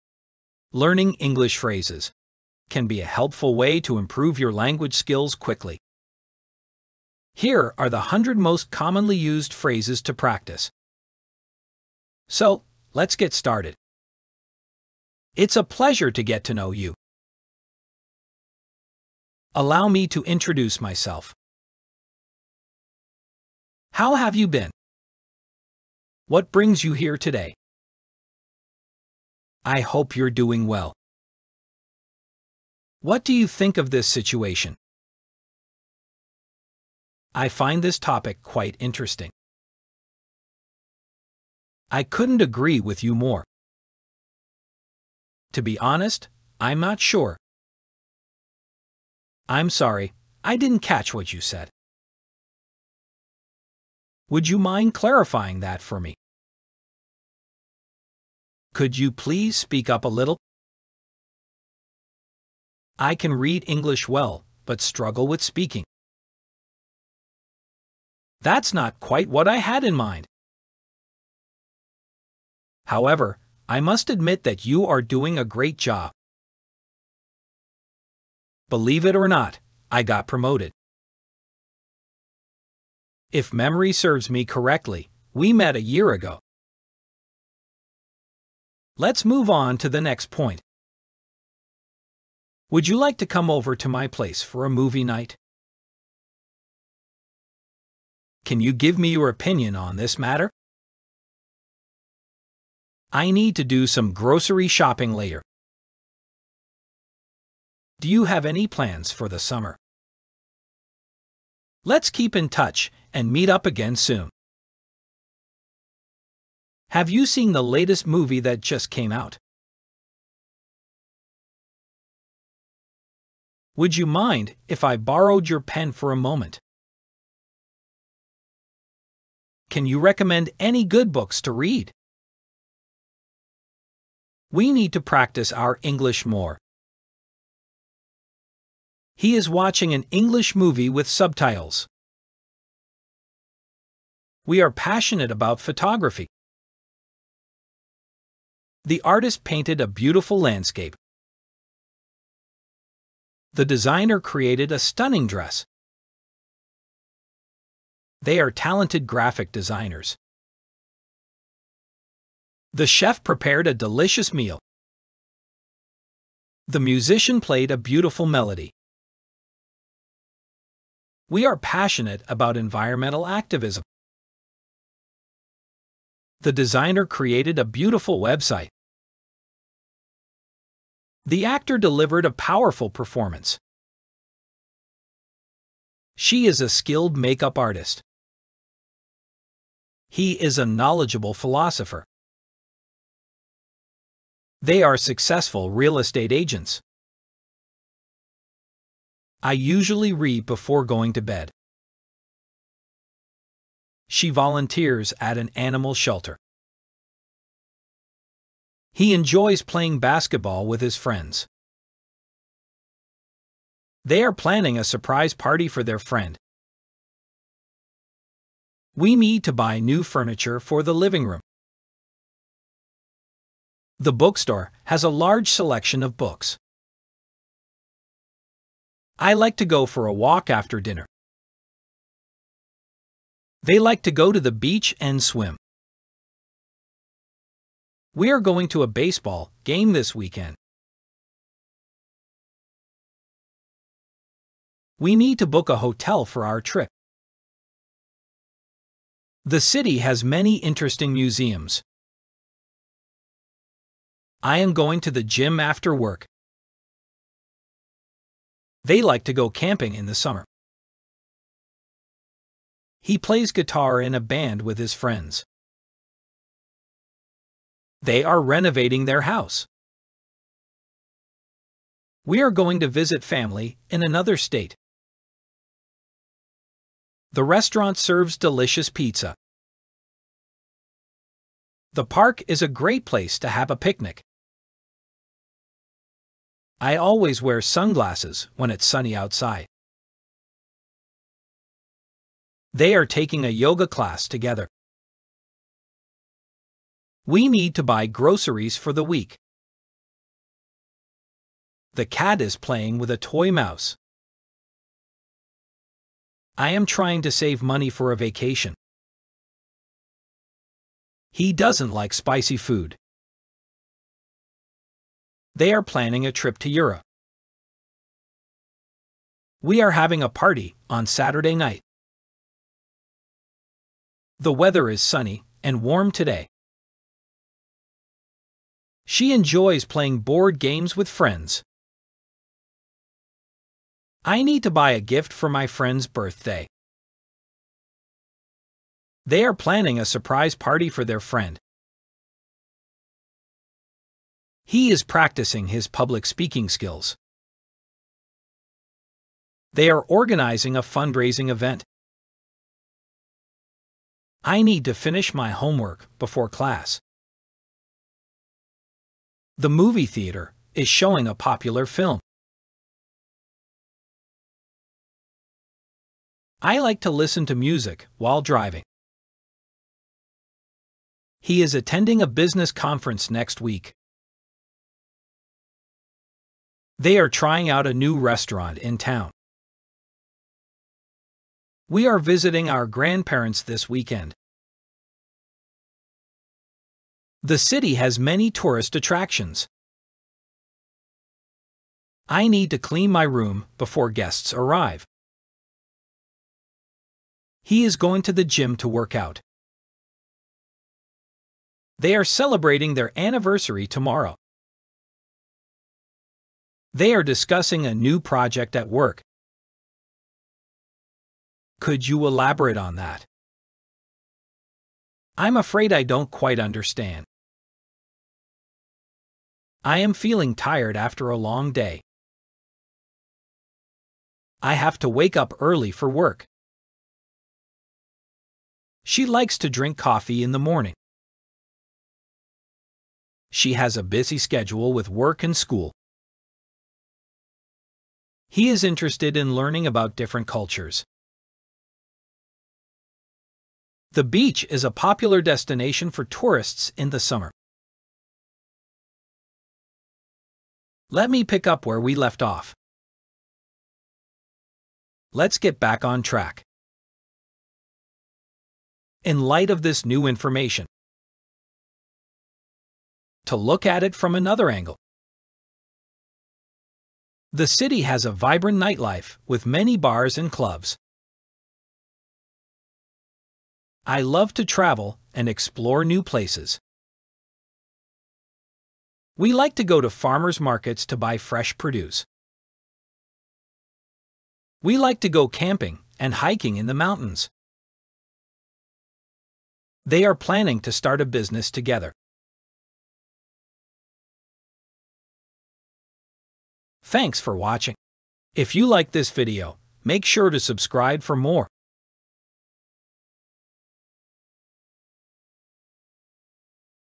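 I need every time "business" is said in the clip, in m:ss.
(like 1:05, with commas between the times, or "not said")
6:12, 8:11.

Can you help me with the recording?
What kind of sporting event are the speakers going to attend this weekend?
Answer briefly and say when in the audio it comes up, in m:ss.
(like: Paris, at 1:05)
baseball game, at 3:58.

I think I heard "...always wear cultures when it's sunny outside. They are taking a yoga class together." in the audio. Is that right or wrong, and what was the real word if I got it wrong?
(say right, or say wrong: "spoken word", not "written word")
wrong: "sunglasses", not "cultures".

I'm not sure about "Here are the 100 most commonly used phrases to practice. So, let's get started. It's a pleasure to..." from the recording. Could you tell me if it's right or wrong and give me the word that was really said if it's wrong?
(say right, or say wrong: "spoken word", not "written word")
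right.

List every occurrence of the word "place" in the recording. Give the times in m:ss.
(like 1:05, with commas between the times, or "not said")
1:34, 4:43, 7:56.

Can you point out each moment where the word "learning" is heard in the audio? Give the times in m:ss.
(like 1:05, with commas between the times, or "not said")
0:00, 7:19.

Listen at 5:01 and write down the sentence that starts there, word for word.
The cat is playing with a toy mouse.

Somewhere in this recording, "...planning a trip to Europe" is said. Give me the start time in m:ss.
5:15.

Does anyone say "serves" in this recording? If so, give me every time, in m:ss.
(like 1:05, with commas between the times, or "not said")
1:23, 4:37.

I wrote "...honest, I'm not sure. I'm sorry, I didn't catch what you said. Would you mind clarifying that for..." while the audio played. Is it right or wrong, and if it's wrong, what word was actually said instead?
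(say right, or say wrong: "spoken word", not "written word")
right.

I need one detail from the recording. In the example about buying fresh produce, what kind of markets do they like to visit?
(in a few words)
farmers markets.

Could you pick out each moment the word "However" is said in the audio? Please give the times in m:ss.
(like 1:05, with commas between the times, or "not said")
1:12.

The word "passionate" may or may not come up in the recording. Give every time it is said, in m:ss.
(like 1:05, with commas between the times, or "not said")
2:24, 2:51.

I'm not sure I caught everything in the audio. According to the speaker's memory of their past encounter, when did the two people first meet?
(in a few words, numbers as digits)
a year ago.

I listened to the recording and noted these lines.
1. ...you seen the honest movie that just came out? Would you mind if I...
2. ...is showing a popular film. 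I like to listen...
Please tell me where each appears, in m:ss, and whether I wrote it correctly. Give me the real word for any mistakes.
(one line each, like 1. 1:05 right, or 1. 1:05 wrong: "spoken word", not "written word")
1. 1:57 wrong: "latest", not "honest"
2. 6:00 right.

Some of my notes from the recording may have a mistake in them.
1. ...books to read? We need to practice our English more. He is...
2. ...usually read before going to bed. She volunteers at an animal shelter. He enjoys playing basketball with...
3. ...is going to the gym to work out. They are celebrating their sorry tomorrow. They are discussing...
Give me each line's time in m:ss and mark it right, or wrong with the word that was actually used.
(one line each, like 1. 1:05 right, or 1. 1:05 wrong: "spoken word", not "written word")
1. 2:11 right
2. 3:19 right
3. 6:37 wrong: "anniversary", not "sorry".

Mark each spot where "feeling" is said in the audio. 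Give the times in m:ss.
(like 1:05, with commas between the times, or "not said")
7:00.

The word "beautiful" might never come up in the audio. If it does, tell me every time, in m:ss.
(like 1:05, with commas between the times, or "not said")
2:29, 2:47, 2:57.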